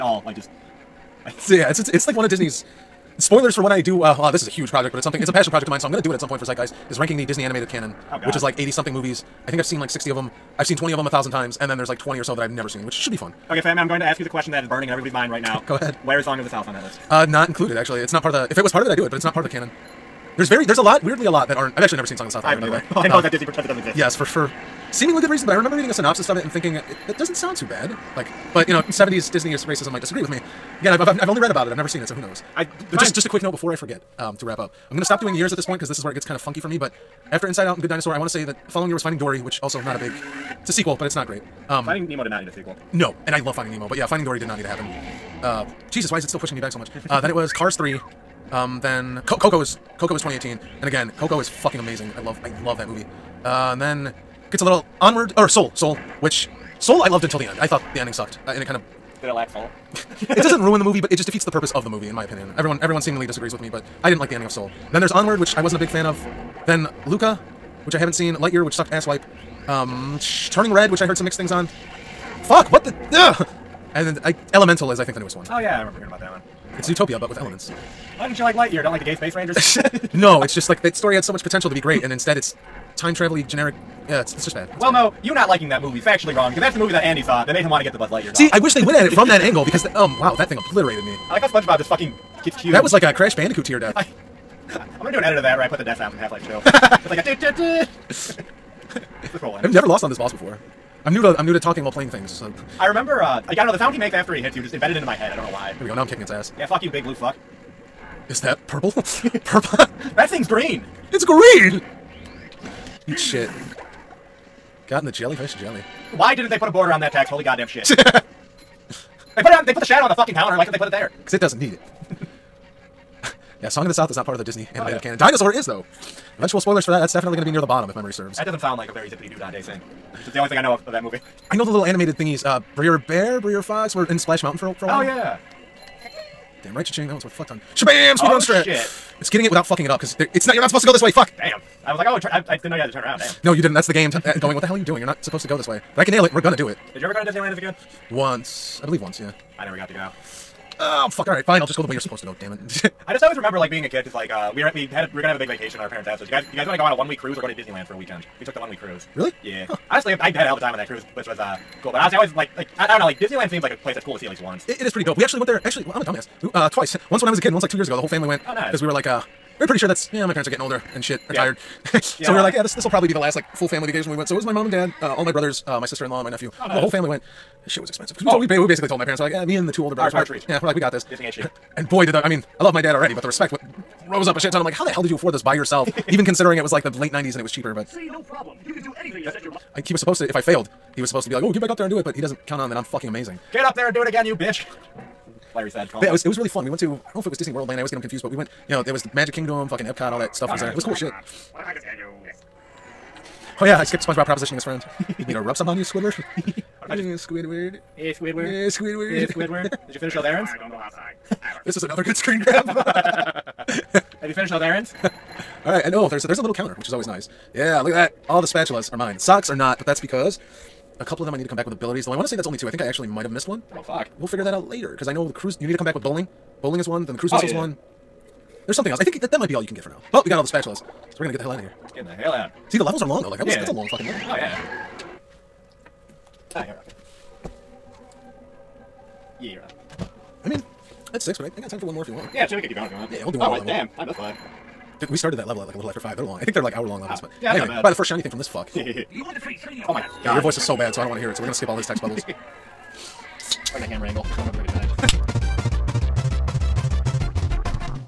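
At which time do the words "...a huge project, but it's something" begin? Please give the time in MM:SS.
00:04.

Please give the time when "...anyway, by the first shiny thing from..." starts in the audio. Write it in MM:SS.
04:07.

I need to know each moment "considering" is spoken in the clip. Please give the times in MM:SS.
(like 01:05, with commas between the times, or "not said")
03:06.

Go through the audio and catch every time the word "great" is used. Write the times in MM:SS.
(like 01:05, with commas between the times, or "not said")
00:41, 01:21.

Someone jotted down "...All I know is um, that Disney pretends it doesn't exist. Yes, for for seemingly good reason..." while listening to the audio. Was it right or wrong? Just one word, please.
right.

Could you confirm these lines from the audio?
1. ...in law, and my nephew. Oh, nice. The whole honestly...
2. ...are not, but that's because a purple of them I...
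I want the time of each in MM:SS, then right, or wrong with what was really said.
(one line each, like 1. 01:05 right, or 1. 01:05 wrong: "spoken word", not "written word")
1. 02:56 wrong: "family", not "honestly"
2. 03:39 wrong: "couple", not "purple".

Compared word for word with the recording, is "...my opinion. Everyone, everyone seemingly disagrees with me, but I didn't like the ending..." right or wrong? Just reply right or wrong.
right.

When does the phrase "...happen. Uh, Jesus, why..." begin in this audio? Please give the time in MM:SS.
00:44.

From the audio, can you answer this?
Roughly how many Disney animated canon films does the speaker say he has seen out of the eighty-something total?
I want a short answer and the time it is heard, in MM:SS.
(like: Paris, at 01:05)
60, at 00:09.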